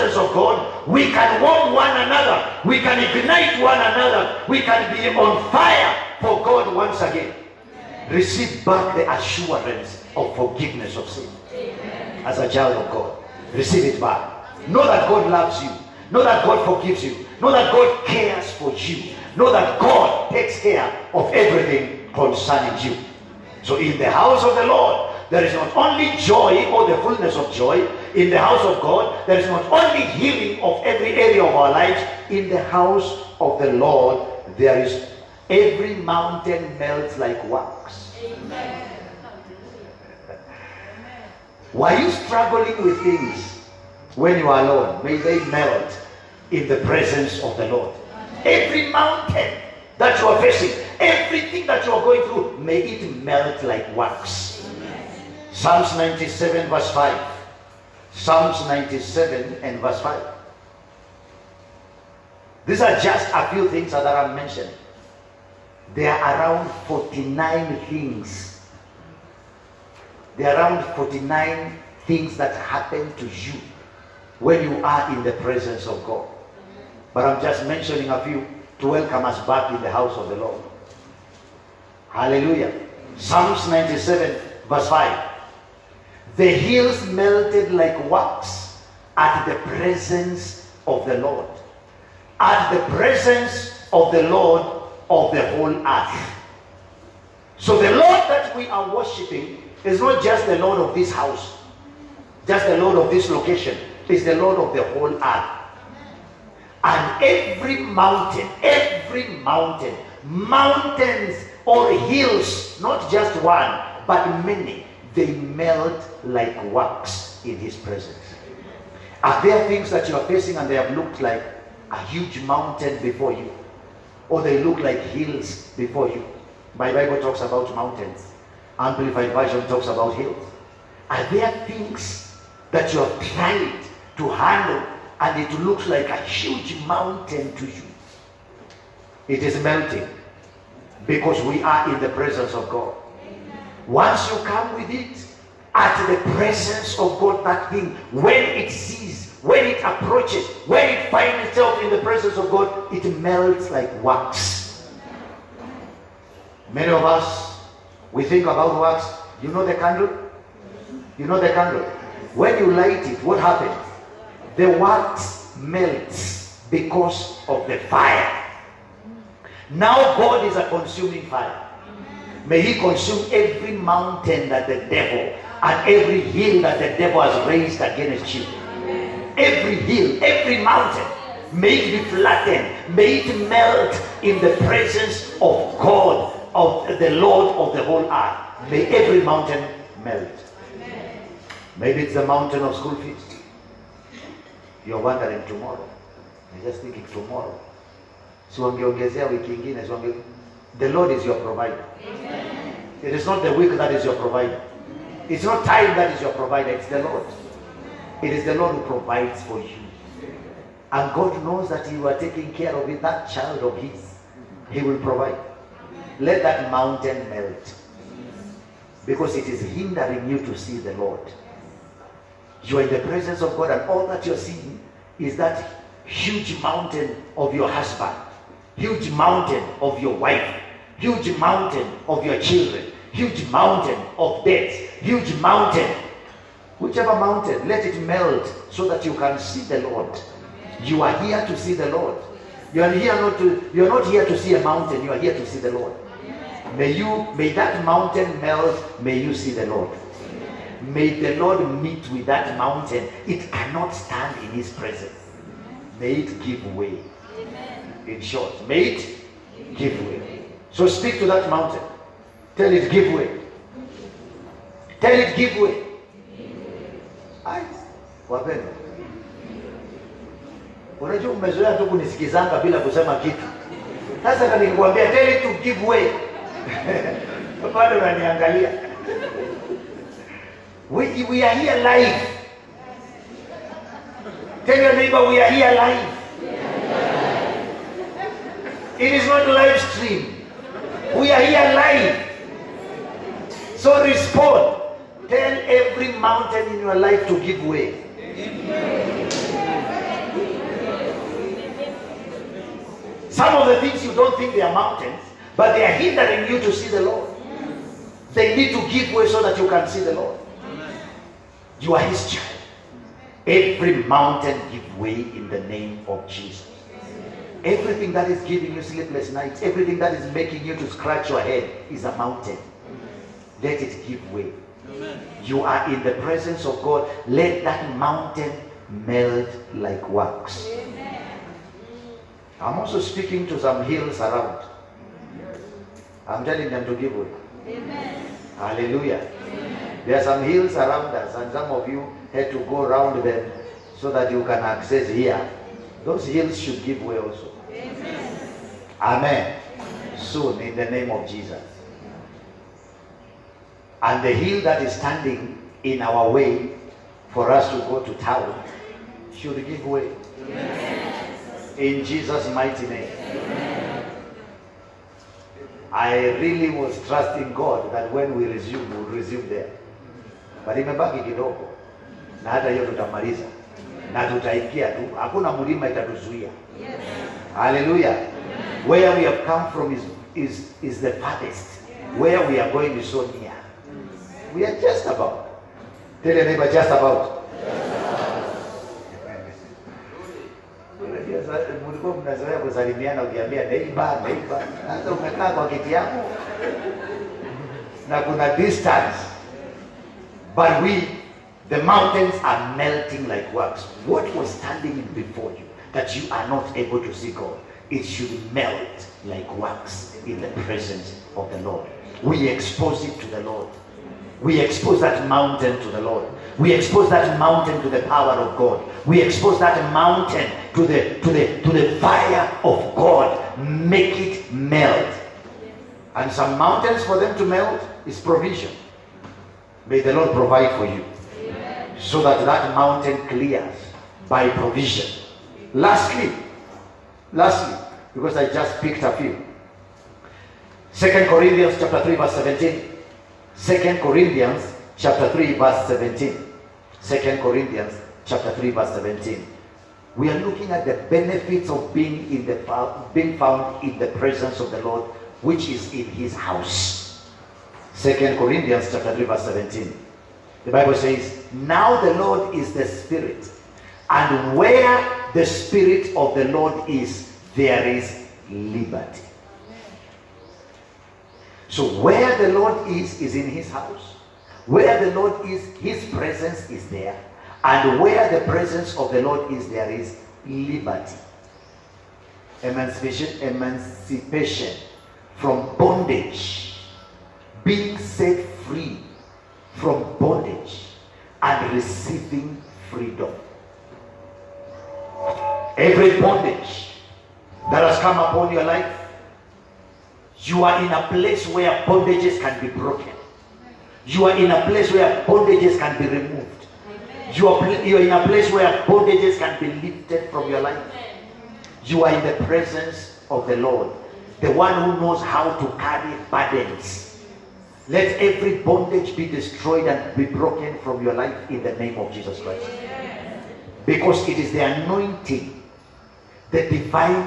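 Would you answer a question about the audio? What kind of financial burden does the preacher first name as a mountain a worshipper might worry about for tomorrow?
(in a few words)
school fees.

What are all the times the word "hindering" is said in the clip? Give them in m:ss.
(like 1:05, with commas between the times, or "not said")
3:39, 5:05.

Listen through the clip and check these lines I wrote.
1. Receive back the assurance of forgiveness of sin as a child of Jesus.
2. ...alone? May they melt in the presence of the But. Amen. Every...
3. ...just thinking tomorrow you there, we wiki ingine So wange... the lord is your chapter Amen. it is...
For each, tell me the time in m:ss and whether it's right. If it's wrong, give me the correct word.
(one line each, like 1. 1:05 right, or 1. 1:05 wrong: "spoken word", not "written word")
1. 0:08 wrong: "God", not "Jesus"
2. 0:44 wrong: "Lord", not "But"
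3. 3:16 wrong: "provider", not "chapter".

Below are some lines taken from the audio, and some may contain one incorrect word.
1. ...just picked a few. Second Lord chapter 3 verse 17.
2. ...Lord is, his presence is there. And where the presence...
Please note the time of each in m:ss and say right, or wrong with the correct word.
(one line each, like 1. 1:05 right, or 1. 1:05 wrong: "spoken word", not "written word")
1. 7:18 wrong: "Corinthians", not "Lord"
2. 7:55 right.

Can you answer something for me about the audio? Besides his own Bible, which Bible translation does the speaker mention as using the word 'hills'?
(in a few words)
Amplified Version.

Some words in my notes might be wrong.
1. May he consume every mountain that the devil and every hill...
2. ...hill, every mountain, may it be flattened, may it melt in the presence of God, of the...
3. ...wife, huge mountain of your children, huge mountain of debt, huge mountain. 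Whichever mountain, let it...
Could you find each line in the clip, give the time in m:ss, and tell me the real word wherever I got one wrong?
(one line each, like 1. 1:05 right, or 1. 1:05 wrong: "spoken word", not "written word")
1. 2:52 right
2. 2:59 right
3. 3:50 right.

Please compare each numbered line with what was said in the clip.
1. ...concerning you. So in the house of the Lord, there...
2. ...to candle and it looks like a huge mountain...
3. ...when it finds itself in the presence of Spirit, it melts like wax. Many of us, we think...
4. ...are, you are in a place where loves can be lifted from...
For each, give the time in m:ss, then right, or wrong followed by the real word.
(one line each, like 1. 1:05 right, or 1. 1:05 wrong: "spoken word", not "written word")
1. 0:22 right
2. 2:14 wrong: "handle", not "candle"
3. 2:30 wrong: "God", not "Spirit"
4. 8:27 wrong: "bondages", not "loves".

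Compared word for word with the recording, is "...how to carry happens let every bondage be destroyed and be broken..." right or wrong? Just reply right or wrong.
wrong.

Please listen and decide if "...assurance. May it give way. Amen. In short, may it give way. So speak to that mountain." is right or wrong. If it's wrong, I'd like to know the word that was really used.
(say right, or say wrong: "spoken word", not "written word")
wrong: "presence", not "assurance".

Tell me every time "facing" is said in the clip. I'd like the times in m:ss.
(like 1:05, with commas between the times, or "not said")
0:50, 2:00.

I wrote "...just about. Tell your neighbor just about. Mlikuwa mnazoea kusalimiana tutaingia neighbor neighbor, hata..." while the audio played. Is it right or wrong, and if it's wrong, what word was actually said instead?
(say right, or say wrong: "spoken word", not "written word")
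wrong: "ukiambia", not "tutaingia".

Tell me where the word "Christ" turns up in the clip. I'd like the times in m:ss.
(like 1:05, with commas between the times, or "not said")
8:42.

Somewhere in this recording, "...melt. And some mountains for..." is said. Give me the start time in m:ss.
7:04.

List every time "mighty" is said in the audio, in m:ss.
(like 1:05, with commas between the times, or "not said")
6:02.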